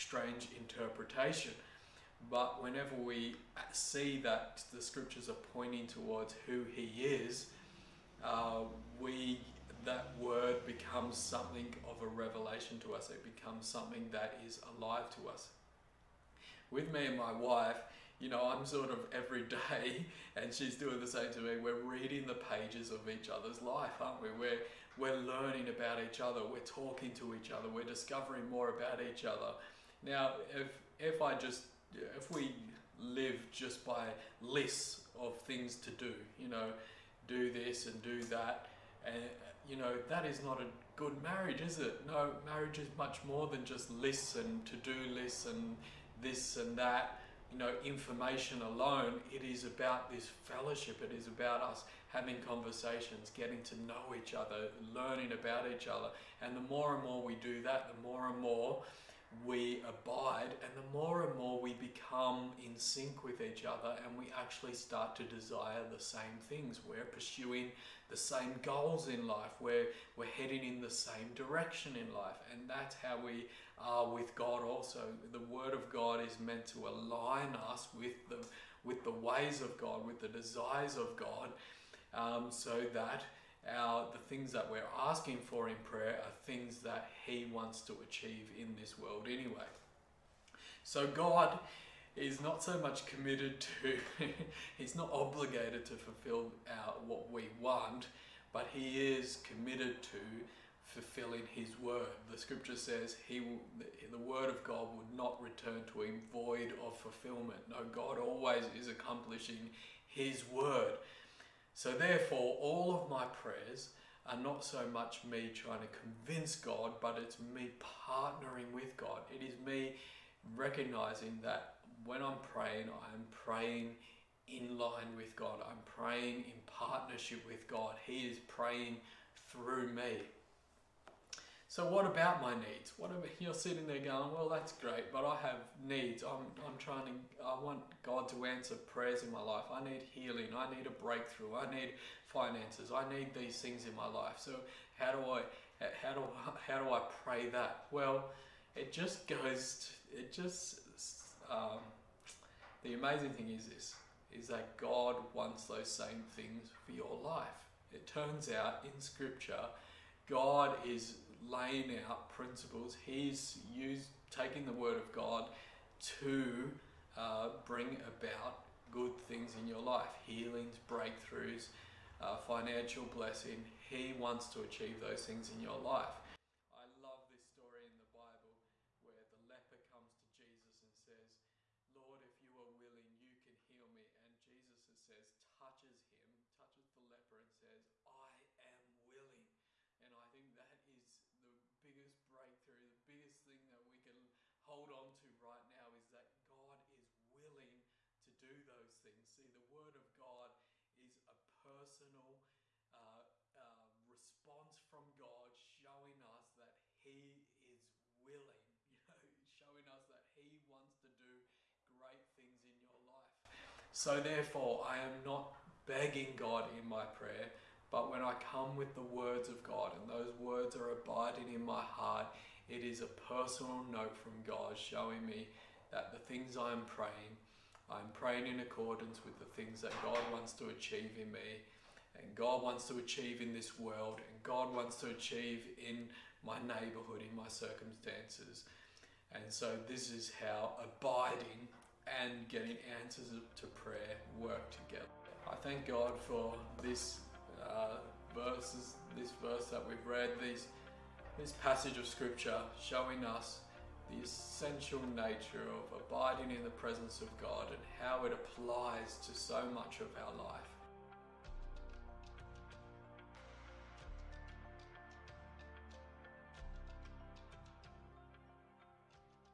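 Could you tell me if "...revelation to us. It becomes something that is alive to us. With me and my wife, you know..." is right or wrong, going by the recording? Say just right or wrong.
right.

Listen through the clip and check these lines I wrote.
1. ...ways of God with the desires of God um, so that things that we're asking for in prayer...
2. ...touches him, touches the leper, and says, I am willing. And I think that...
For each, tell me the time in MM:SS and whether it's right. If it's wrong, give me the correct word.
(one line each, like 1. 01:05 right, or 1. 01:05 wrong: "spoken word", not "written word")
1. 01:19 right
2. 03:05 right.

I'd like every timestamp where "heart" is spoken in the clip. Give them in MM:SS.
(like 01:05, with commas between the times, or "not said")
03:41.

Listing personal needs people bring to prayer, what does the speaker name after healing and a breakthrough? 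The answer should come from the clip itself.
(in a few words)
Finances.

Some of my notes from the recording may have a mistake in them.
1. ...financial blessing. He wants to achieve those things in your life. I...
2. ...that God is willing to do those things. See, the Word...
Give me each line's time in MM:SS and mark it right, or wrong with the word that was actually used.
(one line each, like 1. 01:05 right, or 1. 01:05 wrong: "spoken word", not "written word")
1. 02:52 right
2. 03:16 right.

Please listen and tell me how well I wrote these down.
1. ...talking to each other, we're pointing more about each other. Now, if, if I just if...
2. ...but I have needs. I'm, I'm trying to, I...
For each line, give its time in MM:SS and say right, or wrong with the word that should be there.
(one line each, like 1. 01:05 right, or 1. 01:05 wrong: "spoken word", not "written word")
1. 00:26 wrong: "discovering", not "pointing"
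2. 02:15 right.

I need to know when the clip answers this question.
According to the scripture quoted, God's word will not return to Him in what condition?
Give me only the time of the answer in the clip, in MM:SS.
01:46.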